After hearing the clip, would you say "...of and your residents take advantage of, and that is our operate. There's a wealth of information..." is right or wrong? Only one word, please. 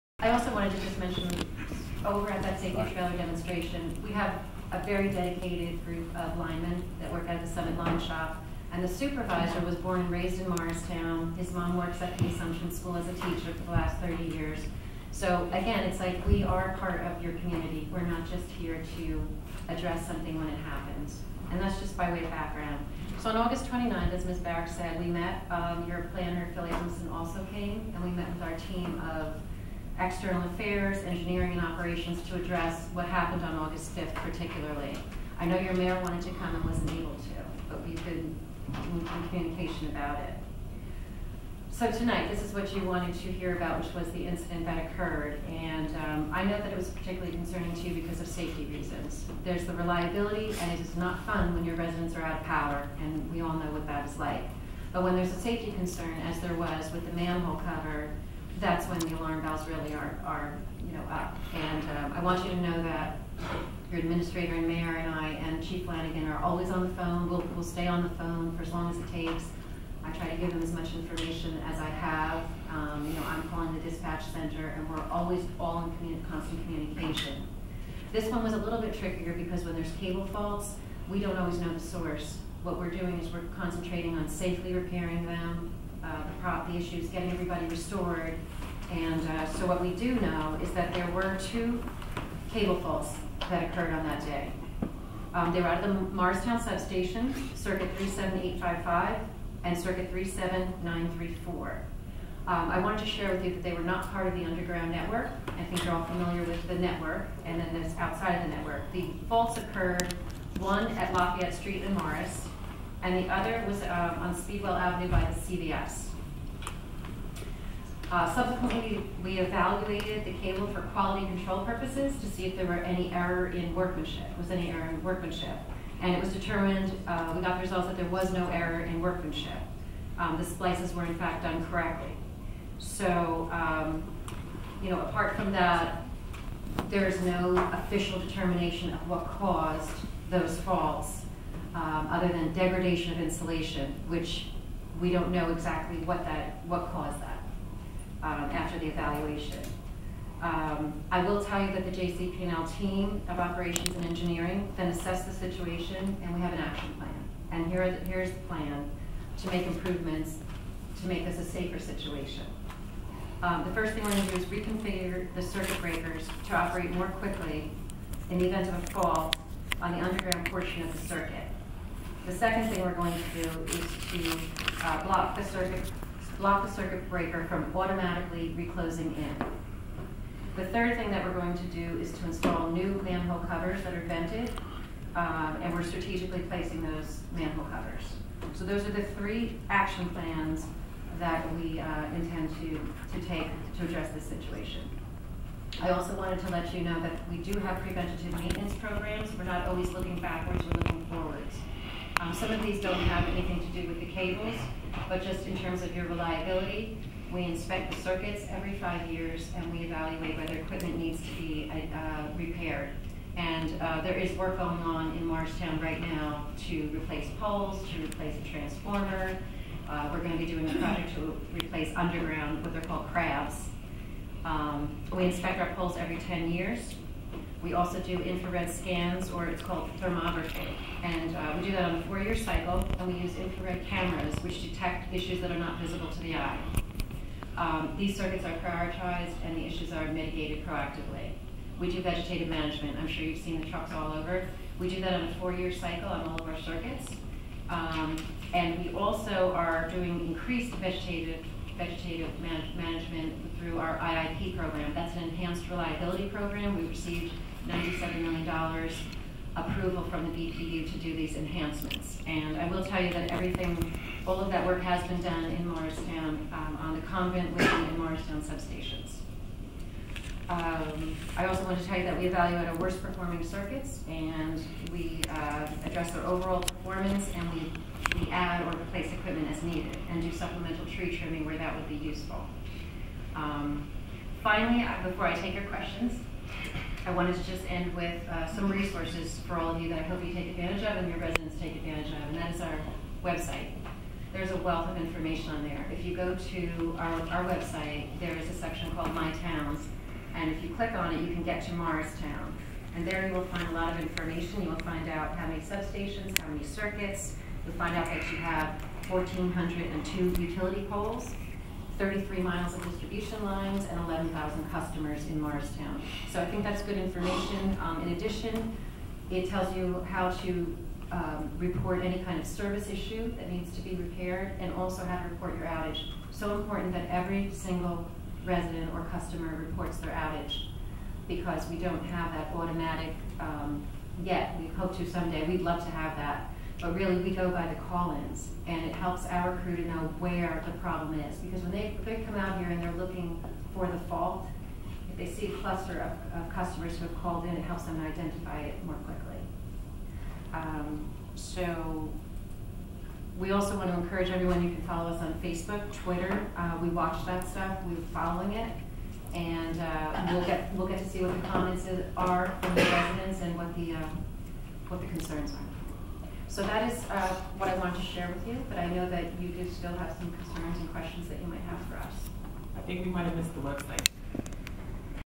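wrong.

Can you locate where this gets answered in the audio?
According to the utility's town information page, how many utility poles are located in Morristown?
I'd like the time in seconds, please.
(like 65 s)
309 s.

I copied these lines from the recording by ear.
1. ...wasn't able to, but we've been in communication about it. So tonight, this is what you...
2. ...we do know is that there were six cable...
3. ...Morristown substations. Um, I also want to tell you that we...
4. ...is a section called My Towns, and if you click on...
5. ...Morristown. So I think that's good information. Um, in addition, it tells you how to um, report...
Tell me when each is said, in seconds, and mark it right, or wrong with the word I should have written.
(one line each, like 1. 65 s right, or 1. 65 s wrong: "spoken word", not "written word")
1. 36 s right
2. 89 s wrong: "two", not "six"
3. 267 s right
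4. 298 s right
5. 315 s right.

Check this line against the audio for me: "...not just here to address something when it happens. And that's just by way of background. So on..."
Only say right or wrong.
right.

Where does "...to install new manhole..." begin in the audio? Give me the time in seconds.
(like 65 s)
182 s.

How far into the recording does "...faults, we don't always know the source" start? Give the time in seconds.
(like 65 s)
80 s.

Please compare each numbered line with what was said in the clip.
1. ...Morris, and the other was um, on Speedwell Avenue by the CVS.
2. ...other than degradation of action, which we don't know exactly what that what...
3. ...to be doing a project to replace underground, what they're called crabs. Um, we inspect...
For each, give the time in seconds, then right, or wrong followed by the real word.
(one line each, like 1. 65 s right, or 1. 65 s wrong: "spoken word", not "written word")
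1. 111 s right
2. 142 s wrong: "insulation", not "action"
3. 220 s right.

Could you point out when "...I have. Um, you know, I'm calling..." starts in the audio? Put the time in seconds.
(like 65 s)
71 s.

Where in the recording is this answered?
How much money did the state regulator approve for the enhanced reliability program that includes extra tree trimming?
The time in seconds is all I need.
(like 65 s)
257 s.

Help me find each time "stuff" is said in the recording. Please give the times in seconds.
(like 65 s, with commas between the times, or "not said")
357 s.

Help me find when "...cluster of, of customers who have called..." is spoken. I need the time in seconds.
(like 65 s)
345 s.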